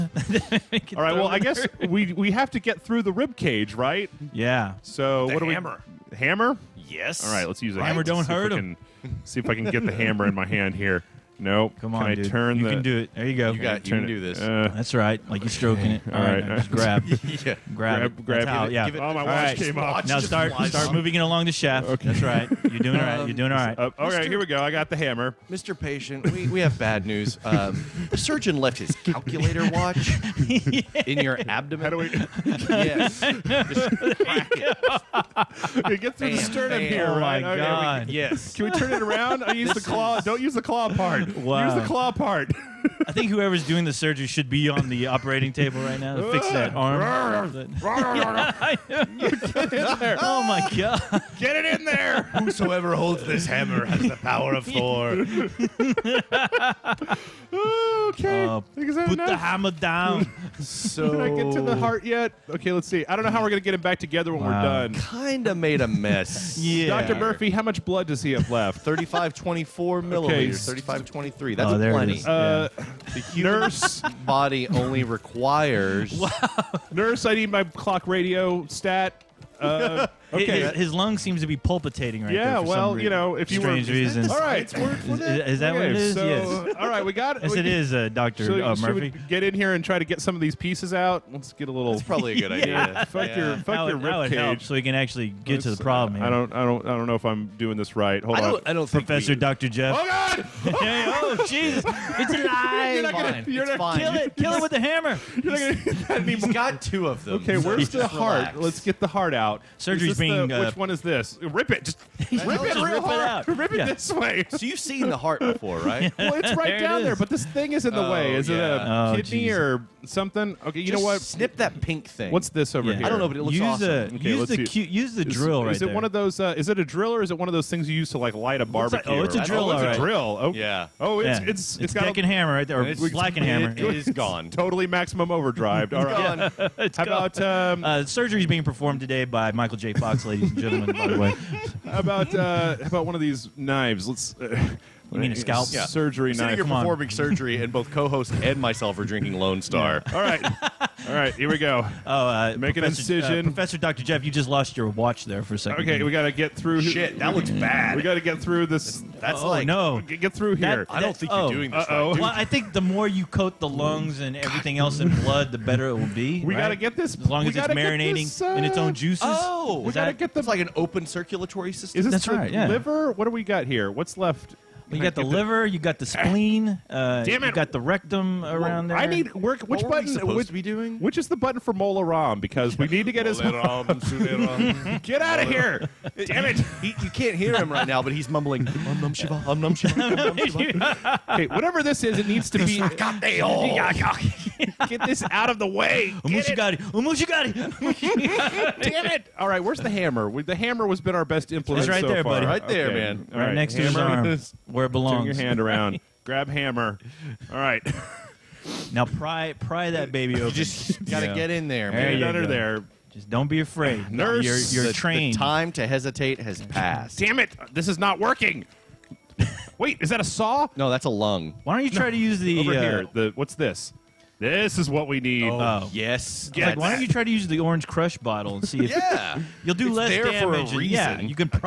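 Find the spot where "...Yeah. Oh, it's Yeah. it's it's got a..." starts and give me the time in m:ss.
2:10.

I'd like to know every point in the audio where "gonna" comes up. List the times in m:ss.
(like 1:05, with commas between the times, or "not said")
1:03, 1:43.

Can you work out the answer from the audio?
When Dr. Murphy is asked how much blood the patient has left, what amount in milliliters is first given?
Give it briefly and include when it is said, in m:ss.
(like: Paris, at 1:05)
3524, at 1:08.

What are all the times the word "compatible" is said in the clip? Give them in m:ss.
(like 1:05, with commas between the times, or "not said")
not said.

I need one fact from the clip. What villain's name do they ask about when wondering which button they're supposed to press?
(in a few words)
Mola Ram.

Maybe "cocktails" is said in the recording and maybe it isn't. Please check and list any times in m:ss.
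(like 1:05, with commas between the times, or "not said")
not said.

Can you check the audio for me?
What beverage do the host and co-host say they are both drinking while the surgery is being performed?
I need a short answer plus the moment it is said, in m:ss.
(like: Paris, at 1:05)
Lone Star, at 2:29.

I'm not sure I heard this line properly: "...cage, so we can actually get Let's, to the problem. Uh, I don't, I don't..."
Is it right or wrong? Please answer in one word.
right.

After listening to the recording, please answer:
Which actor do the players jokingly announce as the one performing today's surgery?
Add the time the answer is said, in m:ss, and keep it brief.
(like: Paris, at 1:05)
Michael J. Fox, at 2:19.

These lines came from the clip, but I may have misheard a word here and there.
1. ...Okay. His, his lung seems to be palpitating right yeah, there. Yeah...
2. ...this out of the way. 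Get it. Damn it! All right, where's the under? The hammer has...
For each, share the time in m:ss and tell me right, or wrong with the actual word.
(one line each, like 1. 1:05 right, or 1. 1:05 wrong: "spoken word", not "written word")
1. 1:20 right
2. 3:15 wrong: "hammer", not "under".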